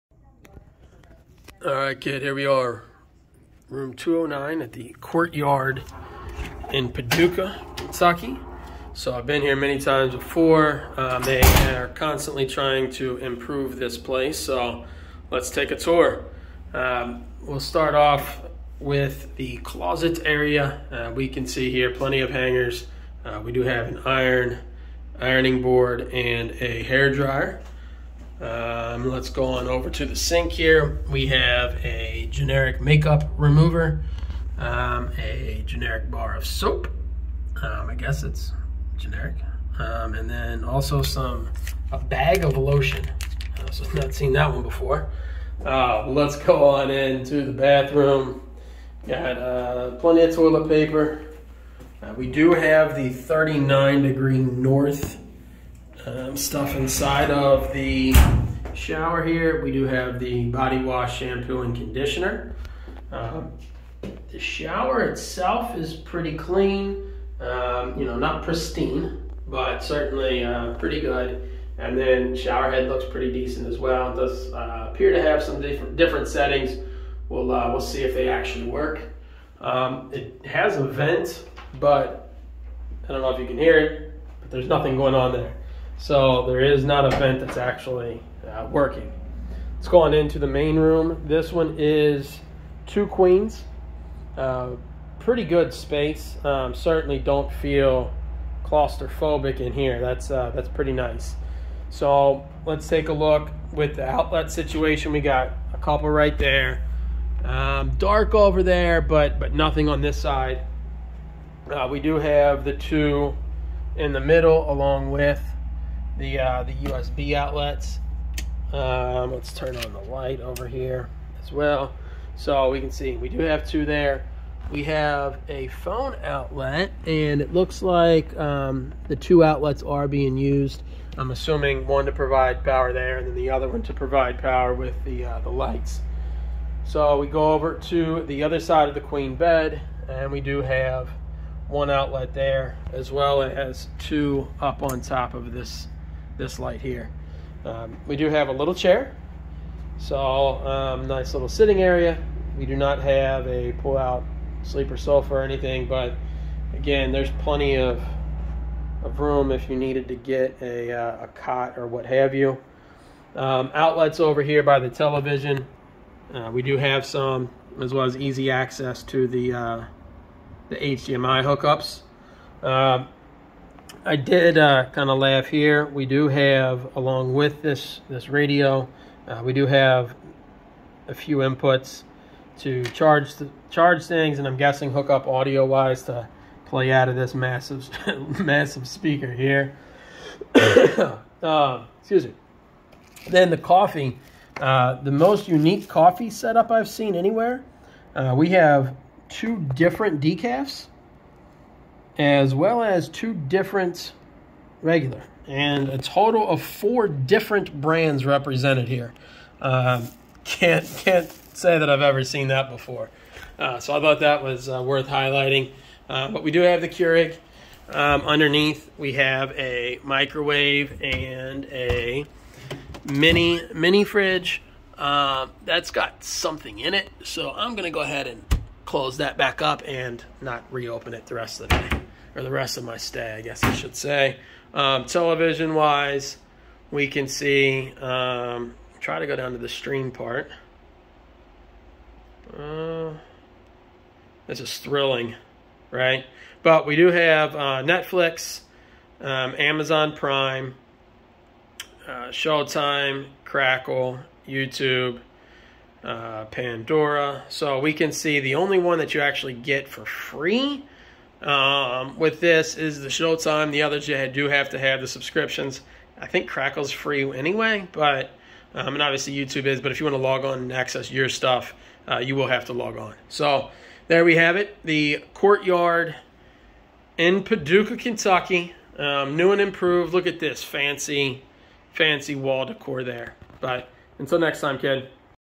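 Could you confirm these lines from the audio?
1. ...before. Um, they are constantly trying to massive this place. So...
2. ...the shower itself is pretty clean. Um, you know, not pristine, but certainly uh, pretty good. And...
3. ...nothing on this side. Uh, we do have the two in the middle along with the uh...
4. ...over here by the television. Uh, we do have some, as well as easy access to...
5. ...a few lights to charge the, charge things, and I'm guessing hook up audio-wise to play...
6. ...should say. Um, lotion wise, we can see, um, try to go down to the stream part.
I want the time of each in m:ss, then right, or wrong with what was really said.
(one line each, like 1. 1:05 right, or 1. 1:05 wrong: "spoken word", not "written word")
1. 0:10 wrong: "improve", not "massive"
2. 1:04 right
3. 1:49 right
4. 2:44 right
5. 3:01 wrong: "inputs", not "lights"
6. 3:53 wrong: "television", not "lotion".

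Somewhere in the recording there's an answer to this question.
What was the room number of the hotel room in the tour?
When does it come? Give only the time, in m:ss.
0:03.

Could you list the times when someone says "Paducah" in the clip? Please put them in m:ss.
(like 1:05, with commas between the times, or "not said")
0:06, 4:37.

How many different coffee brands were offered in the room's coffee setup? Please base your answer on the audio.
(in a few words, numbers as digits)
4.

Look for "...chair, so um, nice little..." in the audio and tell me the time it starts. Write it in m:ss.
2:28.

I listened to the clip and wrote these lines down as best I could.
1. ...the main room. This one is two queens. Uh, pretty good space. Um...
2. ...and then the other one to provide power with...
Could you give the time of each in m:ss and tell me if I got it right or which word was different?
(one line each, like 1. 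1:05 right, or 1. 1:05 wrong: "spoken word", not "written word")
1. 1:30 right
2. 2:13 right.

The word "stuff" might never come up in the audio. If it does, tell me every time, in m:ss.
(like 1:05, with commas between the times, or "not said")
0:56, 4:31.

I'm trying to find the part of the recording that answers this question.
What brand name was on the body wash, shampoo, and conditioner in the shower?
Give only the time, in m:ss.
0:53.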